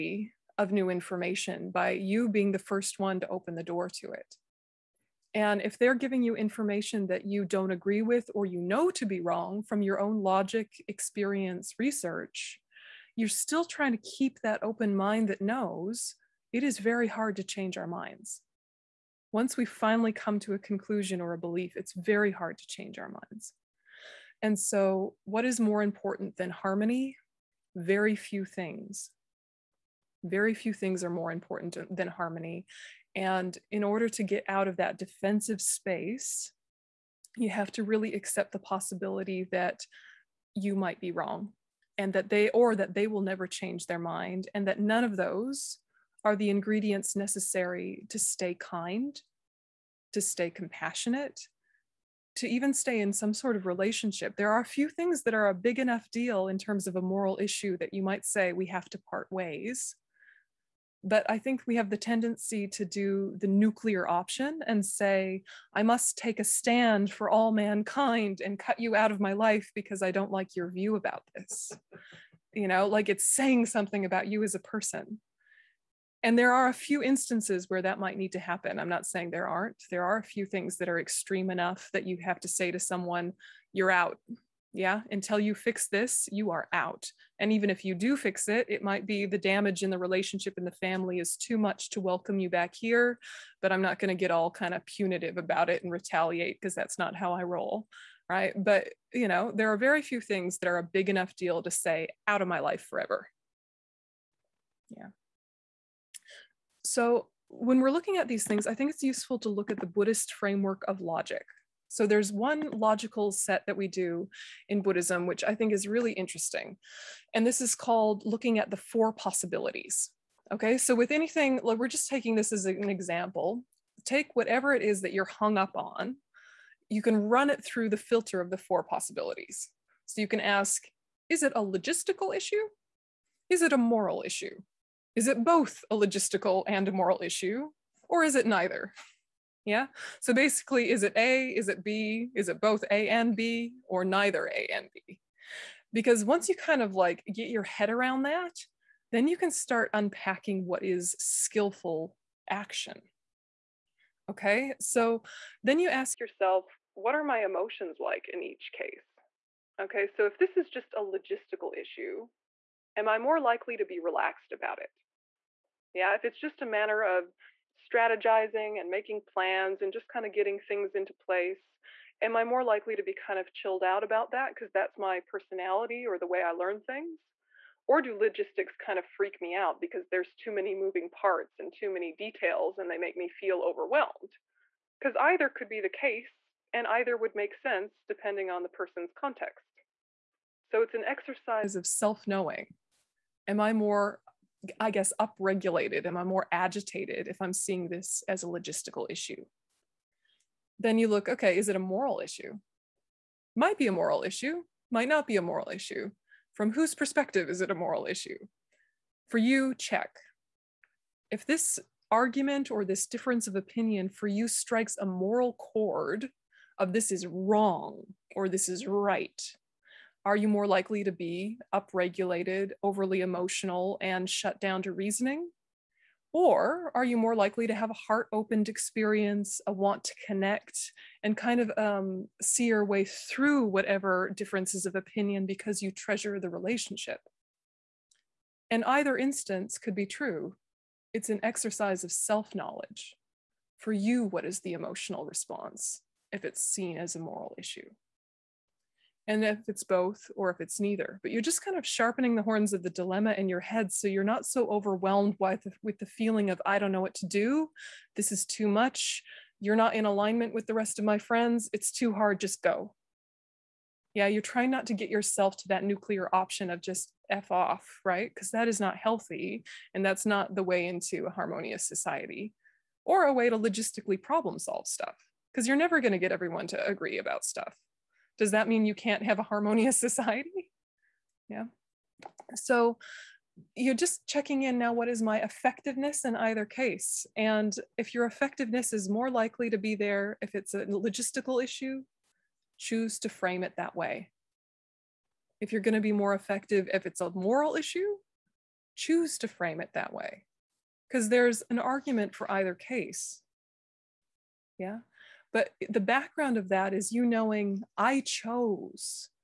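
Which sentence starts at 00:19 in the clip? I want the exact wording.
Once we finally come to a conclusion or a belief, it's very hard to change our minds.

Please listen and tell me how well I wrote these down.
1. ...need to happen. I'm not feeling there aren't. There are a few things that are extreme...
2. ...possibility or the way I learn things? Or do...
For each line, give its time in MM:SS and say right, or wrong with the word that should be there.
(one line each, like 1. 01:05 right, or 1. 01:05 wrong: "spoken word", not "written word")
1. 01:18 wrong: "saying", not "feeling"
2. 02:55 wrong: "personality", not "possibility".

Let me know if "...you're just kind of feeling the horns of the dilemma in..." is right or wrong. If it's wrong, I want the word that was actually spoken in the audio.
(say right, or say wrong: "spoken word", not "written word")
wrong: "sharpening", not "feeling".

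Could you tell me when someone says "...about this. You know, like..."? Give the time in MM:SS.
01:10.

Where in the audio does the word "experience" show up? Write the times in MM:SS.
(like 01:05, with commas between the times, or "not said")
00:10, 03:48.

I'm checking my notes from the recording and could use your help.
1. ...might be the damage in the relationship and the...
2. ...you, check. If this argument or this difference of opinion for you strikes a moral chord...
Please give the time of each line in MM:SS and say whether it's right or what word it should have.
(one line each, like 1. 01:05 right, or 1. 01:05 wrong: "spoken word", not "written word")
1. 01:28 right
2. 03:29 right.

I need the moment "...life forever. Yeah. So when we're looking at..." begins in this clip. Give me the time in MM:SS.
01:42.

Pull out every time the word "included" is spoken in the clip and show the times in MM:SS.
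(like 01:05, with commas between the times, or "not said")
not said.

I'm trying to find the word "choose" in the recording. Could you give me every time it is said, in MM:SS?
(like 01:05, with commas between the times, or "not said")
04:52, 04:58.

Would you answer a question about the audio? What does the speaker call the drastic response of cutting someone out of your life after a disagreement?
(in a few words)
the nuclear option.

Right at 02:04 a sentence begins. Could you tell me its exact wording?
Take whatever it is that you're hung up on, you can run it through the filter of the four possibilities.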